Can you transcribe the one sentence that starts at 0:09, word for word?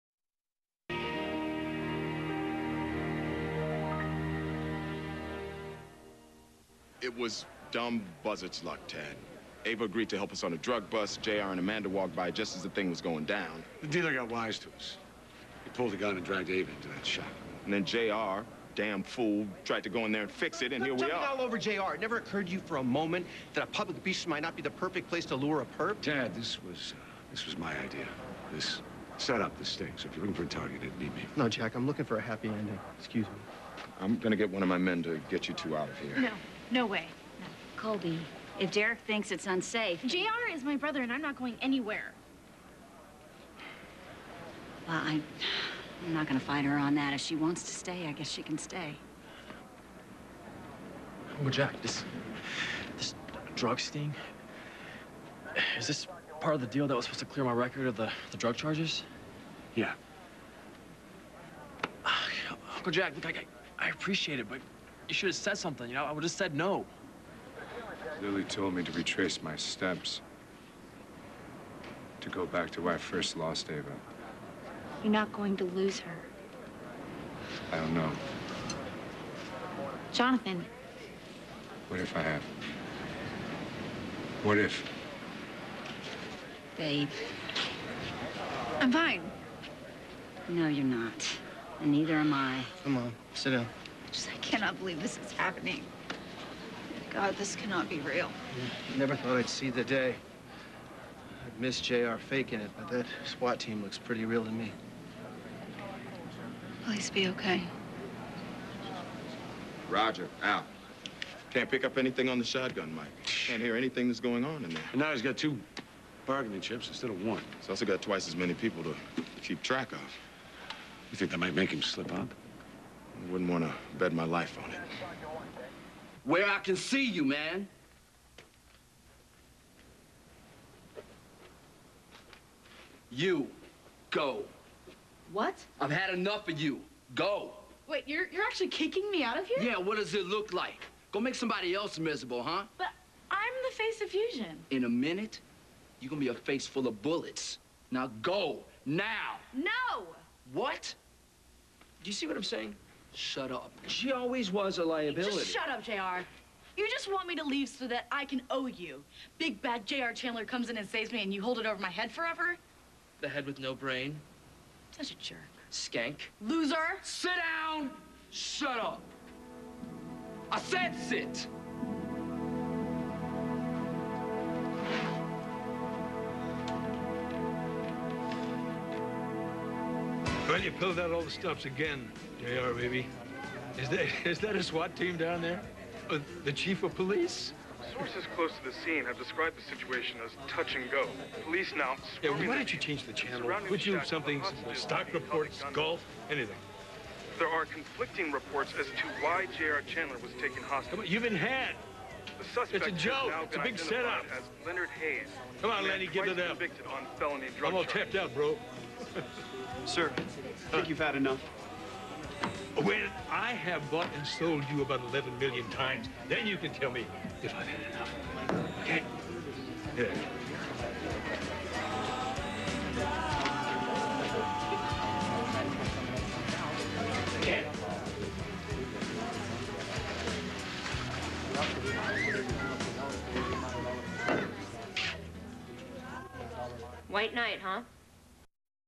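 Ava agreed to help us on a drug bust.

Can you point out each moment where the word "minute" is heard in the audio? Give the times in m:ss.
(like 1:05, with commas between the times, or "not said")
2:24.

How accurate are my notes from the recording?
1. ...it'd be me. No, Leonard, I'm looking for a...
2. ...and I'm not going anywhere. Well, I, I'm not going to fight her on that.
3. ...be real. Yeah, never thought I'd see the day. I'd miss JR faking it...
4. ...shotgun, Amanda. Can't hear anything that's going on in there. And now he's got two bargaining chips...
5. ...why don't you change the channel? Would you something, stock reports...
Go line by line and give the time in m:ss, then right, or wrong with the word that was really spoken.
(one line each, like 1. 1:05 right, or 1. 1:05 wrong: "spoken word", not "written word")
1. 0:30 wrong: "Jack", not "Leonard"
2. 0:41 right
3. 1:37 right
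4. 1:52 wrong: "Mike", not "Amanda"
5. 3:12 right.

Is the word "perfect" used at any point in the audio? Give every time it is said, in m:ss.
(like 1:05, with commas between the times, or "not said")
0:24.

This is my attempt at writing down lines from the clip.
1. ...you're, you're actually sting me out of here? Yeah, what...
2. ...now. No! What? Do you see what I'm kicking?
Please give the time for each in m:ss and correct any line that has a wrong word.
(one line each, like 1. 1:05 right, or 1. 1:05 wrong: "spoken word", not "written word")
1. 2:18 wrong: "kicking", not "sting"
2. 2:28 wrong: "saying", not "kicking".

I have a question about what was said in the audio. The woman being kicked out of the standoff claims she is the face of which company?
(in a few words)
Fusion.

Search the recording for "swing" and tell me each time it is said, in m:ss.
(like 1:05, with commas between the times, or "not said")
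not said.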